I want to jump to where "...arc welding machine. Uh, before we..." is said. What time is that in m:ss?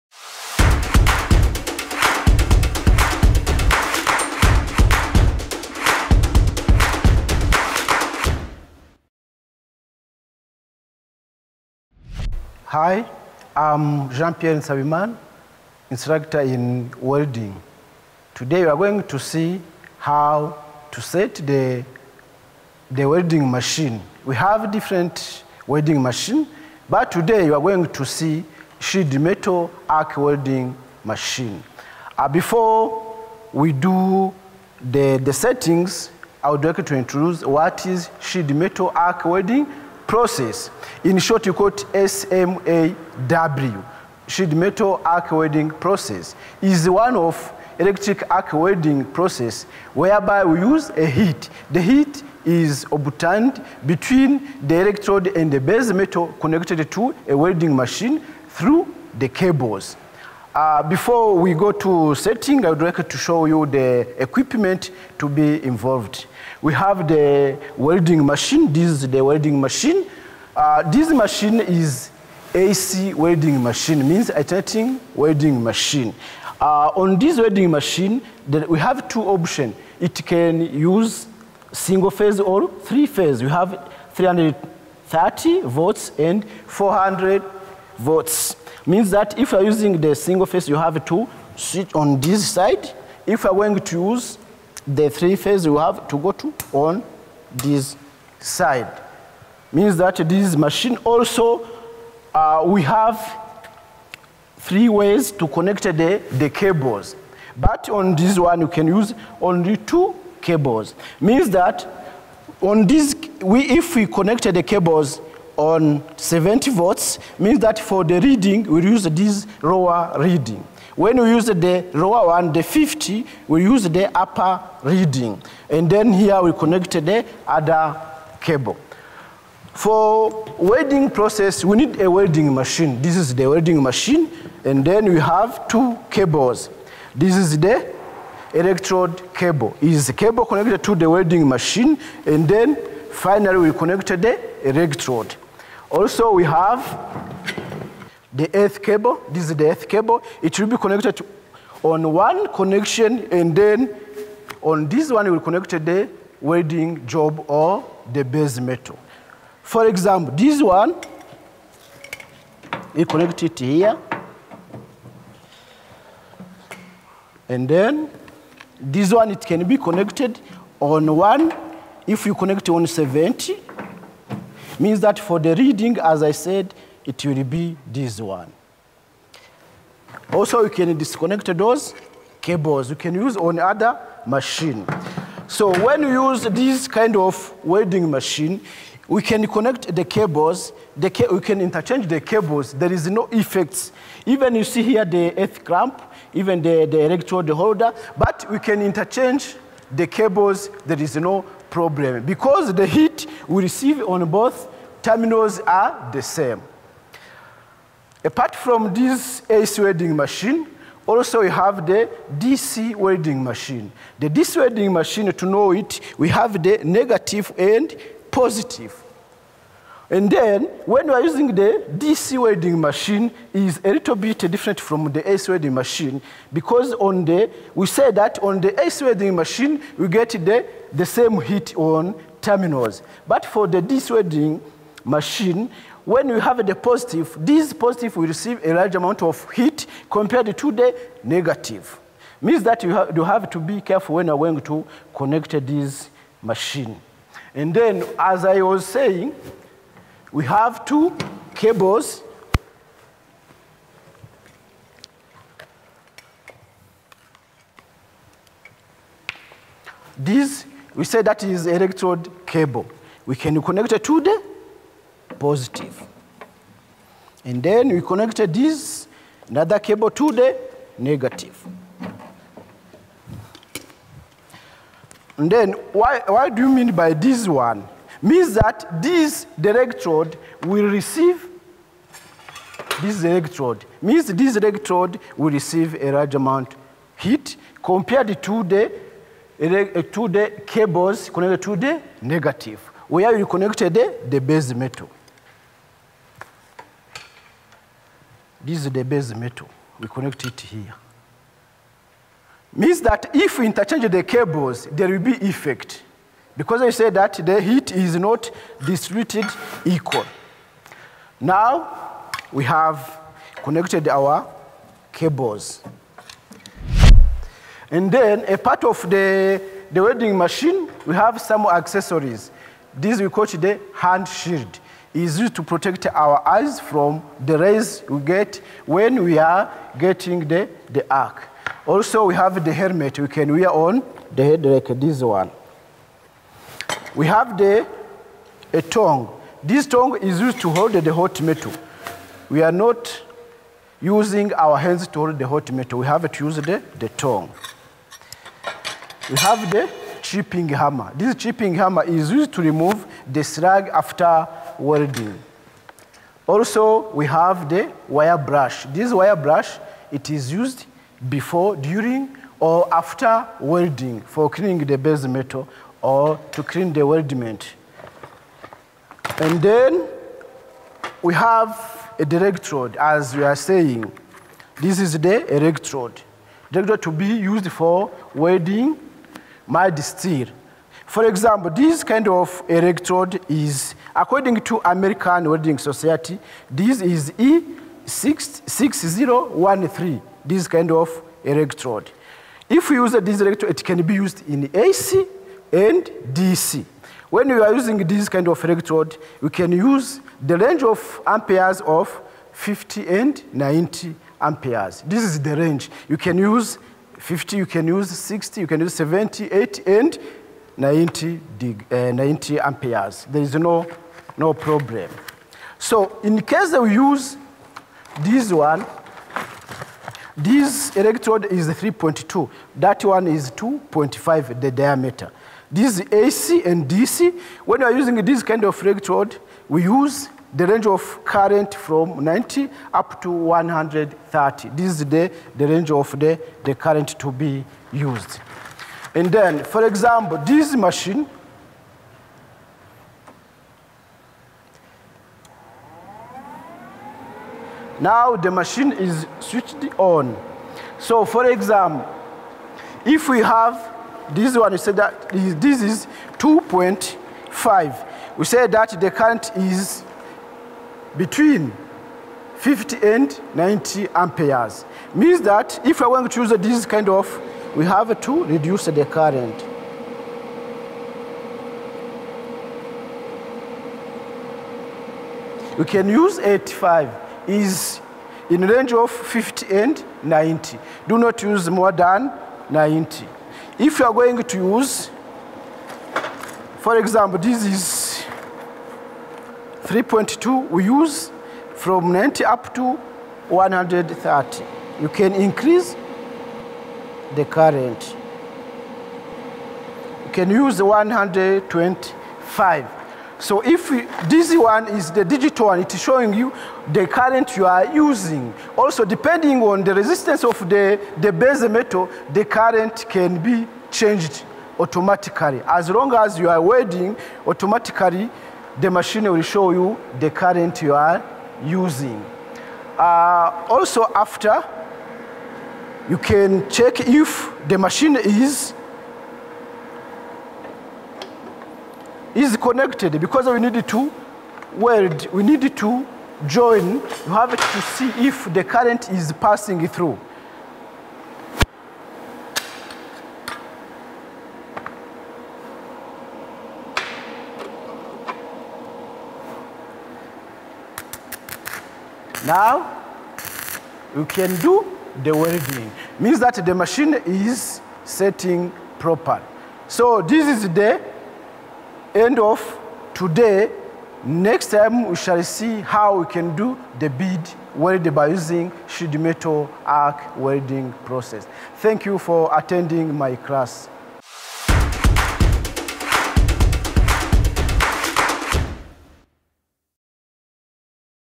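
0:29.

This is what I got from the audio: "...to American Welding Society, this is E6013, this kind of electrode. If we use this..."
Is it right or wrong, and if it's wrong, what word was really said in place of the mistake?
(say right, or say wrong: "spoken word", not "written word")
right.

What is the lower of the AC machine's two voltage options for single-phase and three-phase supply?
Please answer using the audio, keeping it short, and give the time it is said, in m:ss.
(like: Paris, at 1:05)
330 volts, at 1:24.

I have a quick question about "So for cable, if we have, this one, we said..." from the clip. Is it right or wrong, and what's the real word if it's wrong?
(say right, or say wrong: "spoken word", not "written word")
wrong: "example", not "cable".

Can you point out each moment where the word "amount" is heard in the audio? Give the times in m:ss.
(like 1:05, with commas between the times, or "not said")
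3:58, 4:46.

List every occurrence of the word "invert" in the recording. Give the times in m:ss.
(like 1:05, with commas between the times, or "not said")
not said.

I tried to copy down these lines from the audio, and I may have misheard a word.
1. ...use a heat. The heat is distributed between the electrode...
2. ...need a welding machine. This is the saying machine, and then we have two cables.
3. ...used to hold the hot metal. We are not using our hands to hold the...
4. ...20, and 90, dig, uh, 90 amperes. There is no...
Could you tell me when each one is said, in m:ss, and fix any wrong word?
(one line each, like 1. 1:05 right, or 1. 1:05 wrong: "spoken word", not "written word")
1. 0:50 wrong: "obtained", not "distributed"
2. 2:11 wrong: "welding", not "saying"
3. 5:40 right
4. 6:49 wrong: "80", not "20".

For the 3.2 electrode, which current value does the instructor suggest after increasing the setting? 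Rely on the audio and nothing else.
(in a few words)
125 amperes.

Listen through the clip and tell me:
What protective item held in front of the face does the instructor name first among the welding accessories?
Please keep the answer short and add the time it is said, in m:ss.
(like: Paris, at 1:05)
hand shield, at 5:23.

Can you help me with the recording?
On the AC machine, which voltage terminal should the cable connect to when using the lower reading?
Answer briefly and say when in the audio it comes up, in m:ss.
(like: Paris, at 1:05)
70 volts, at 1:56.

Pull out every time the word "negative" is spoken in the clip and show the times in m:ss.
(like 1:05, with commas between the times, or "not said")
3:36, 4:01, 4:30, 4:52.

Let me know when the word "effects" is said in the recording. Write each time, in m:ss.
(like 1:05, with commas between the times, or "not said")
3:13, 5:05.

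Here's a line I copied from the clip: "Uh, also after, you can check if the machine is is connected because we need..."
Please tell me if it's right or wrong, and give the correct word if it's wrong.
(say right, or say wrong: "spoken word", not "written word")
right.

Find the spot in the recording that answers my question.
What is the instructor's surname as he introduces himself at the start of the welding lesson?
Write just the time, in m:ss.
0:14.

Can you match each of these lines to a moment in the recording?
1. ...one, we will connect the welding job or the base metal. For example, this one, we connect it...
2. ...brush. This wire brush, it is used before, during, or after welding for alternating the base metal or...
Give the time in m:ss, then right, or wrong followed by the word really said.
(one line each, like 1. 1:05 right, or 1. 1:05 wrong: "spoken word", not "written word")
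1. 2:35 right
2. 5:58 wrong: "cleaning", not "alternating".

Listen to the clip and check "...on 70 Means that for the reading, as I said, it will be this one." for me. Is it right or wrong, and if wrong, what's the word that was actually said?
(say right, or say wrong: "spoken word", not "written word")
right.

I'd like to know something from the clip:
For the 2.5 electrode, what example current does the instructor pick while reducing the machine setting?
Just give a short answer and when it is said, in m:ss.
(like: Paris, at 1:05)
85 amperes, at 7:56.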